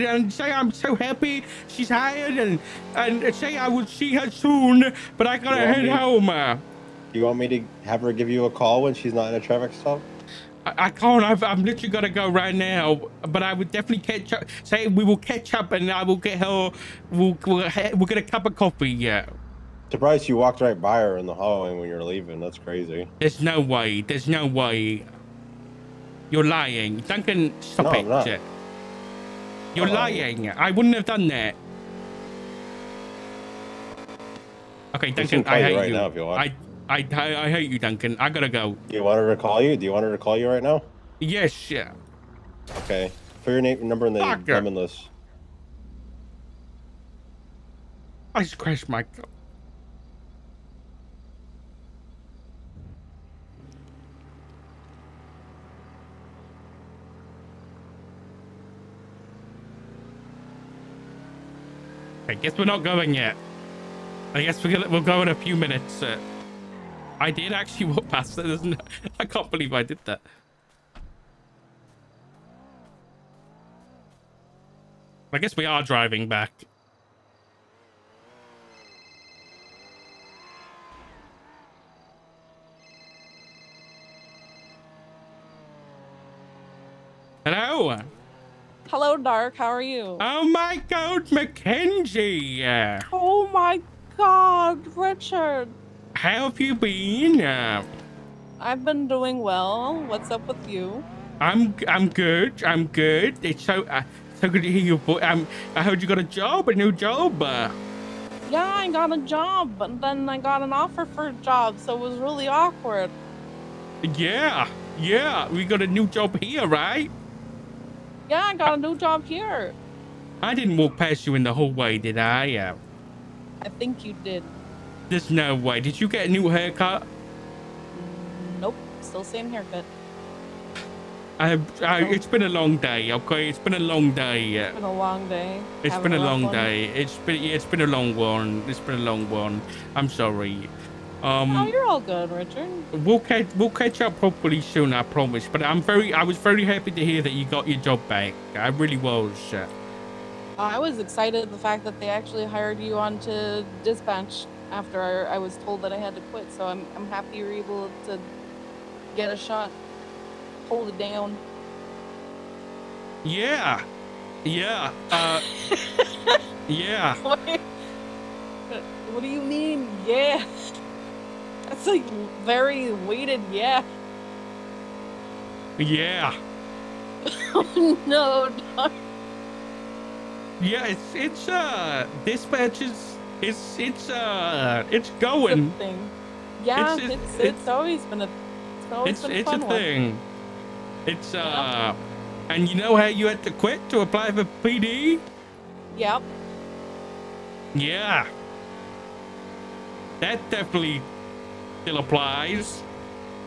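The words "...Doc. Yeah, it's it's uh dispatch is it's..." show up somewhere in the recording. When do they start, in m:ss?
2:58.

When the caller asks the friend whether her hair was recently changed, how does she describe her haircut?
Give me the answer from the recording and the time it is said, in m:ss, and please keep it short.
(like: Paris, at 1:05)
Same haircut, at 2:09.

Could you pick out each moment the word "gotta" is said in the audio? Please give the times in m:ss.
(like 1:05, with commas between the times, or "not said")
0:05, 0:38.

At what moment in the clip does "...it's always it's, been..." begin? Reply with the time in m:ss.
3:08.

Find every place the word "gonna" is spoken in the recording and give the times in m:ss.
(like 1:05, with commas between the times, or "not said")
0:11, 1:04.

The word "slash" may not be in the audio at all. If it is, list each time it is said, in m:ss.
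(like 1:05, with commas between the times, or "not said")
not said.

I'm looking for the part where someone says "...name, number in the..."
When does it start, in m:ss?
0:43.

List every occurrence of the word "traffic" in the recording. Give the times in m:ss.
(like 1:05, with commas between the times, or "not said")
0:09.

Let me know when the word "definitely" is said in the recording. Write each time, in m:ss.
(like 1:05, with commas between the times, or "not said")
0:13, 3:20.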